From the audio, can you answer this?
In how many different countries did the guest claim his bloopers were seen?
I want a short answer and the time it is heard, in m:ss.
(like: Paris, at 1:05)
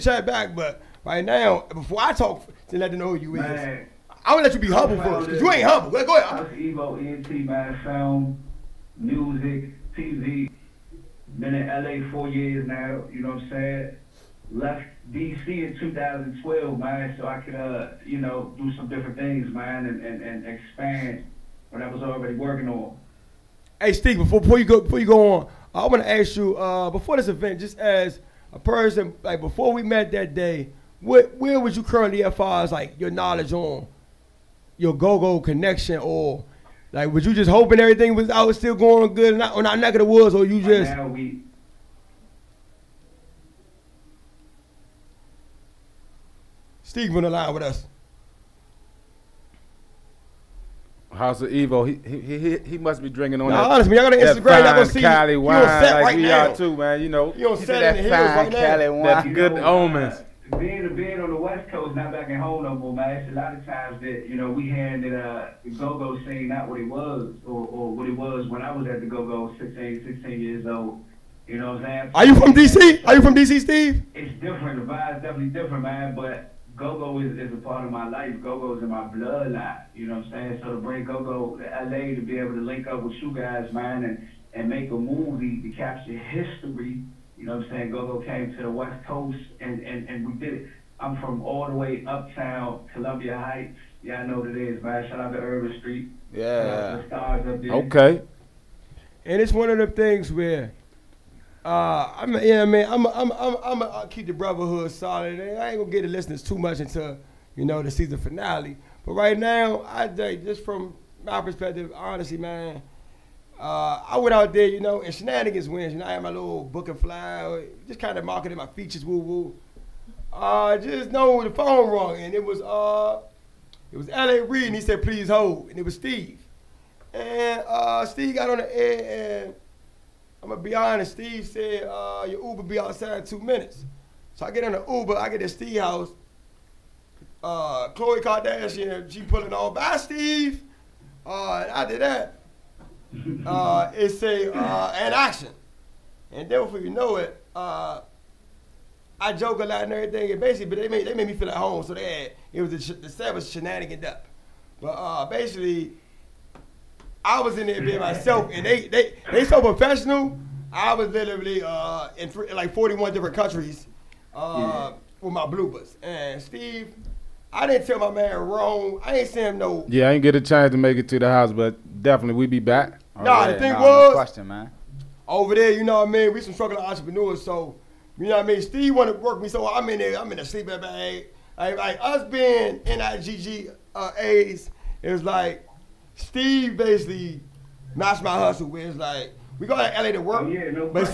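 41, at 2:42.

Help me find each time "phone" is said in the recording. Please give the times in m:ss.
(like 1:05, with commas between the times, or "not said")
2:01.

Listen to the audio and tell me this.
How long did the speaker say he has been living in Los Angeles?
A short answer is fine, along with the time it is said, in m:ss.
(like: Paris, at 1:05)
4 years, at 0:12.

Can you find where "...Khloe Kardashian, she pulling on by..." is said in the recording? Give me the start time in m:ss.
2:17.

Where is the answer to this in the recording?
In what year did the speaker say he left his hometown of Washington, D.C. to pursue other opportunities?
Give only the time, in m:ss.
0:15.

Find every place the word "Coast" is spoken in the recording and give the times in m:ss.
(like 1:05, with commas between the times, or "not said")
1:01, 1:29.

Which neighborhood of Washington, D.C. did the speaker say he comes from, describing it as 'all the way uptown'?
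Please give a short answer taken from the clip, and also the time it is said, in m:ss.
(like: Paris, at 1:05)
Columbia Heights, at 1:32.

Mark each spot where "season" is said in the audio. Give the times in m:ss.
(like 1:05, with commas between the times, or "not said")
1:47.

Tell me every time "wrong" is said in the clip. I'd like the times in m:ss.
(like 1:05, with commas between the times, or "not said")
2:01, 2:48.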